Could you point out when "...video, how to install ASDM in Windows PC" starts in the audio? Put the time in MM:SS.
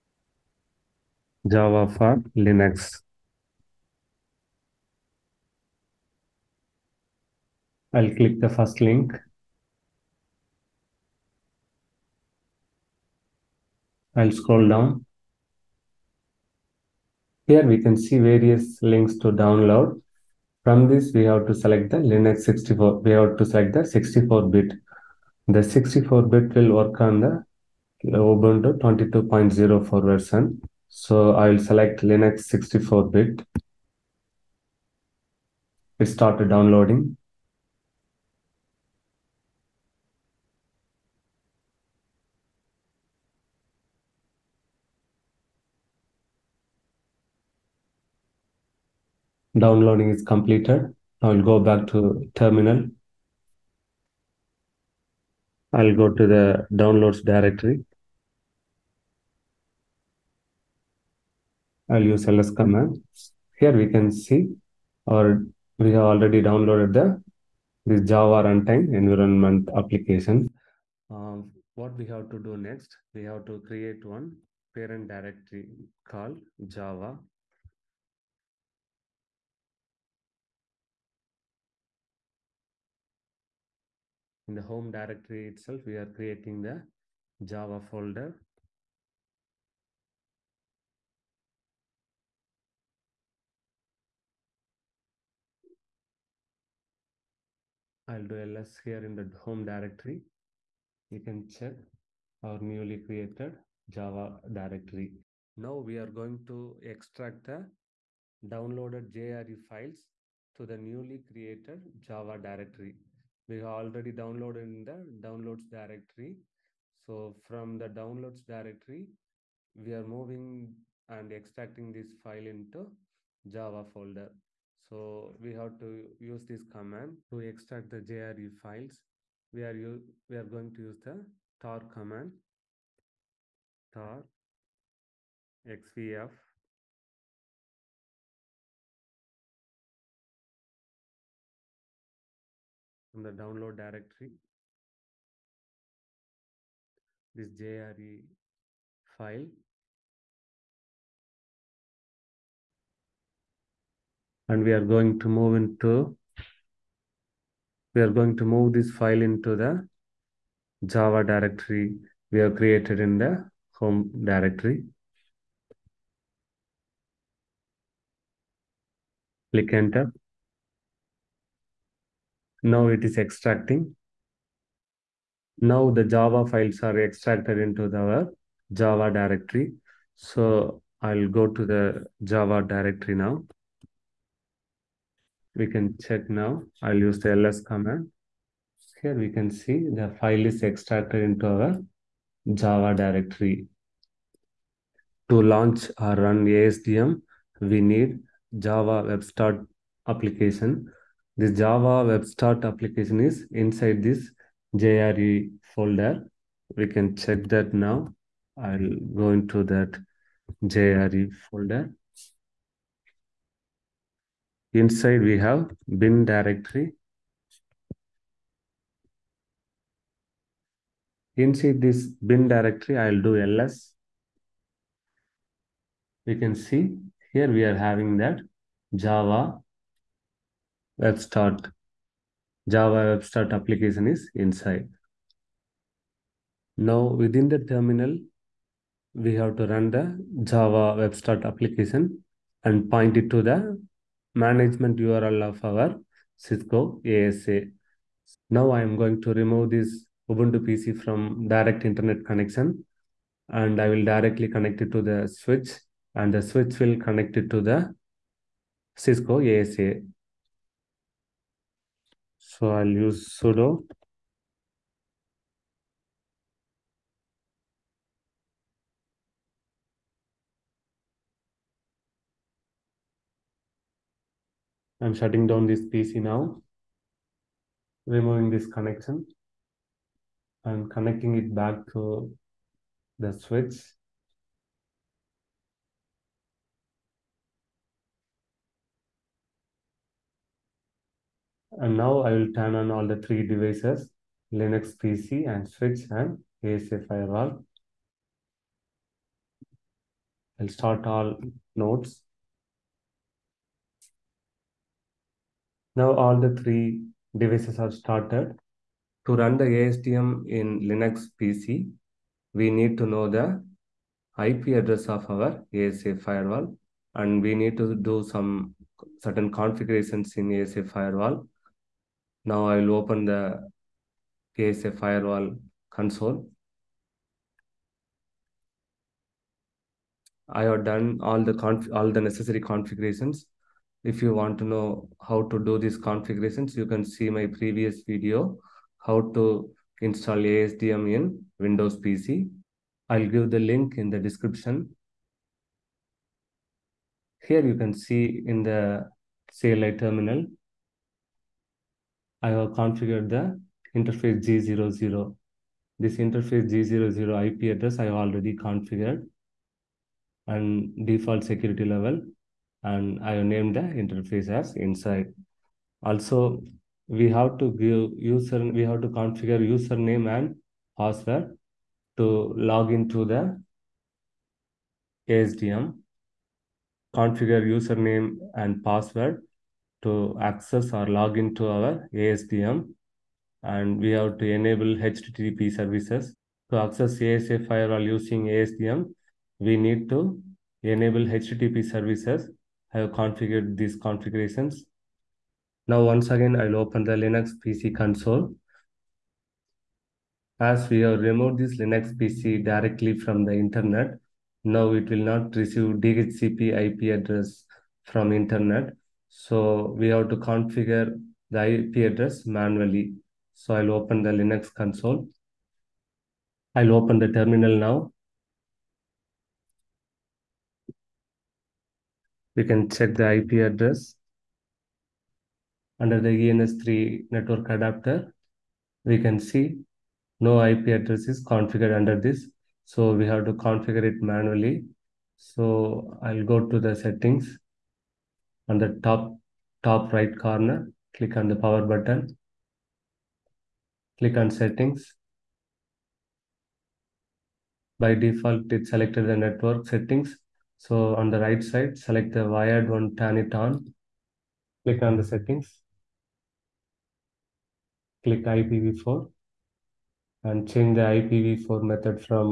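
05:38.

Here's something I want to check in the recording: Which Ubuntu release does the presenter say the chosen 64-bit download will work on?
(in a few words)
22.04.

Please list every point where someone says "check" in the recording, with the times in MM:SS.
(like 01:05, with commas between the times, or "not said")
01:41, 03:05, 03:27, 07:02.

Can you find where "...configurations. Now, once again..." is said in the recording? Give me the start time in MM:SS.
06:33.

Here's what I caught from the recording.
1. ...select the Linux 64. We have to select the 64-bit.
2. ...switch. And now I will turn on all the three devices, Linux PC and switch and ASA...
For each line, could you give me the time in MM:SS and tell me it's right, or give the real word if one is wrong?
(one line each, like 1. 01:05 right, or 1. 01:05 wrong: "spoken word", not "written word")
1. 00:21 right
2. 04:43 right.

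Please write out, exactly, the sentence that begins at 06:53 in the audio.
So I'll open the Linux console.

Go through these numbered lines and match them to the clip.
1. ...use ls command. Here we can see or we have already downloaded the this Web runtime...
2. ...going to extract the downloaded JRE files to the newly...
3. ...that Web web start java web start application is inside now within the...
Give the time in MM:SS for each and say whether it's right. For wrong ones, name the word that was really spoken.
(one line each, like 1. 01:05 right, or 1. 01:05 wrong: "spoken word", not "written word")
1. 01:02 wrong: "Java", not "Web"
2. 01:46 right
3. 03:48 wrong: "Java", not "Web".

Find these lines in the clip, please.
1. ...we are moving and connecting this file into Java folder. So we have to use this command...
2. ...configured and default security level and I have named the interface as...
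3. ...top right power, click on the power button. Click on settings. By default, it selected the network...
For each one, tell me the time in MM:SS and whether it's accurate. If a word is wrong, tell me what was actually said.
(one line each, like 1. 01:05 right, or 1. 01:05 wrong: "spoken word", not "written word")
1. 01:59 wrong: "extracting", not "connecting"
2. 05:58 right
3. 07:19 wrong: "corner", not "power".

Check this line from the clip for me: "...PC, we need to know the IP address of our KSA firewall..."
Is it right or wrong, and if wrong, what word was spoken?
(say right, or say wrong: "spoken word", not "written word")
wrong: "ASA", not "KSA".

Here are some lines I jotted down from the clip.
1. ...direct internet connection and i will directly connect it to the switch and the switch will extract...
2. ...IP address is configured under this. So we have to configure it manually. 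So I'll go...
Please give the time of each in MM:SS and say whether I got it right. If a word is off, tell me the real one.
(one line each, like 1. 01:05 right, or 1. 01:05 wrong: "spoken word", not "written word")
1. 04:11 wrong: "connect", not "extract"
2. 07:10 right.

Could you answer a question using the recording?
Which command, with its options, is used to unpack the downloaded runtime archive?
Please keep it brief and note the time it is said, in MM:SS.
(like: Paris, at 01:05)
tar xvf, at 02:13.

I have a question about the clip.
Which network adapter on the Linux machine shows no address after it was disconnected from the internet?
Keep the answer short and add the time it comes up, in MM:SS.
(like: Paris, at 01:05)
ENS3, at 07:06.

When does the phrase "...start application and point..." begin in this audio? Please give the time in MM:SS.
04:01.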